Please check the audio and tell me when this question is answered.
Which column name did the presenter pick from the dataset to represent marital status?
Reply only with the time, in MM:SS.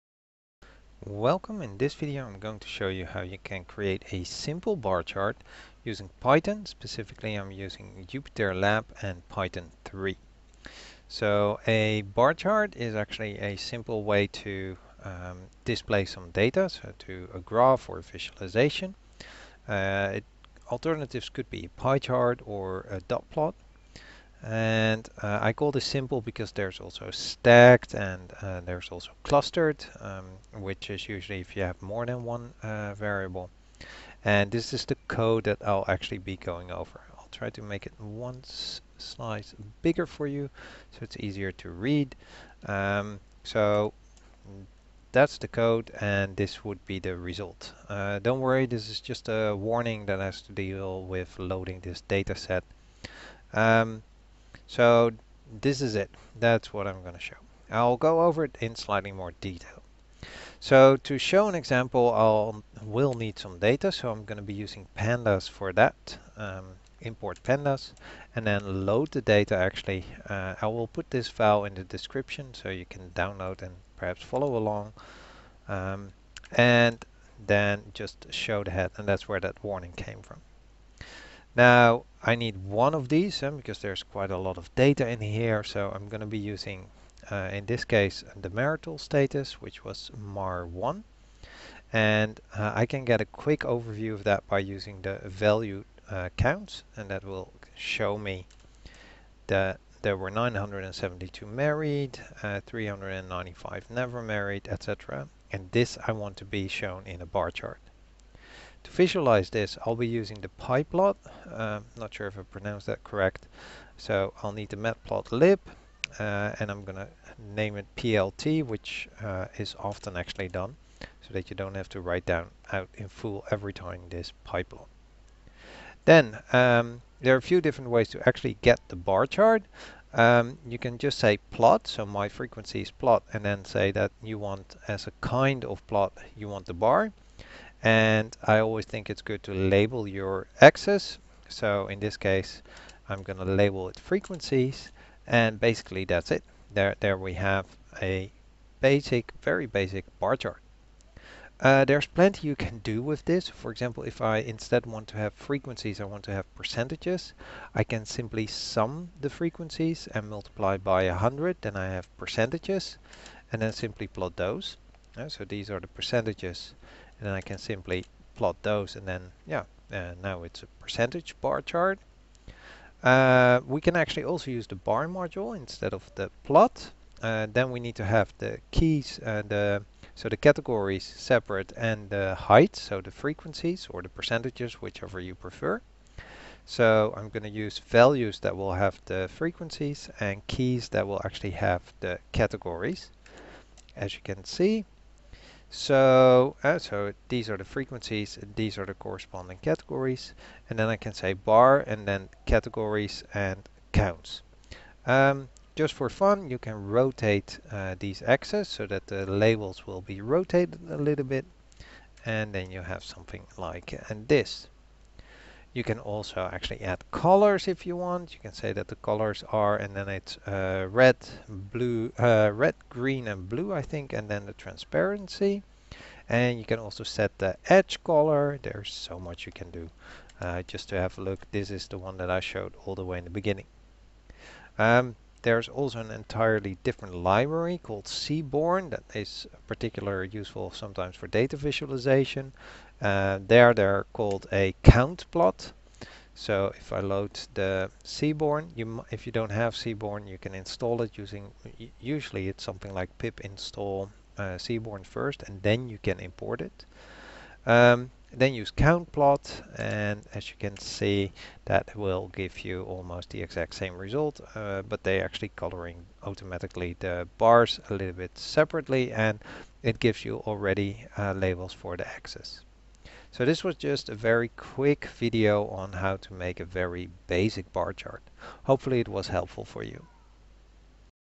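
01:30.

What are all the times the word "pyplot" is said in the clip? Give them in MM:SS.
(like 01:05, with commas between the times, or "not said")
01:50, 02:04.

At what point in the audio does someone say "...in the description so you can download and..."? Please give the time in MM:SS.
01:11.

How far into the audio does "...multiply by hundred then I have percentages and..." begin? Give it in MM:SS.
02:40.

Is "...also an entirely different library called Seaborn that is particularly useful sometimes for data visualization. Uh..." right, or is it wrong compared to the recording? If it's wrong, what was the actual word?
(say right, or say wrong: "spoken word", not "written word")
right.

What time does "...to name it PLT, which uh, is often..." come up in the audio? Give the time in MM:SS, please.
01:56.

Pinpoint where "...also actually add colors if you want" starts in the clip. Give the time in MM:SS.
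03:35.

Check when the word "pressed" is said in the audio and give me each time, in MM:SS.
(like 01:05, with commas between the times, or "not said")
not said.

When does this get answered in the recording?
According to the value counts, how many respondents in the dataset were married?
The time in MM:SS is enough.
01:40.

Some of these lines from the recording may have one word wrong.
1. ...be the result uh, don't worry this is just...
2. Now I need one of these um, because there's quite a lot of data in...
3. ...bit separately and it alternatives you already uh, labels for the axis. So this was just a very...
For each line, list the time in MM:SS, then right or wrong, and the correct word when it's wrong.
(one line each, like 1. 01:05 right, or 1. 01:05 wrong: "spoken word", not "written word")
1. 00:46 right
2. 01:21 right
3. 04:28 wrong: "gives", not "alternatives".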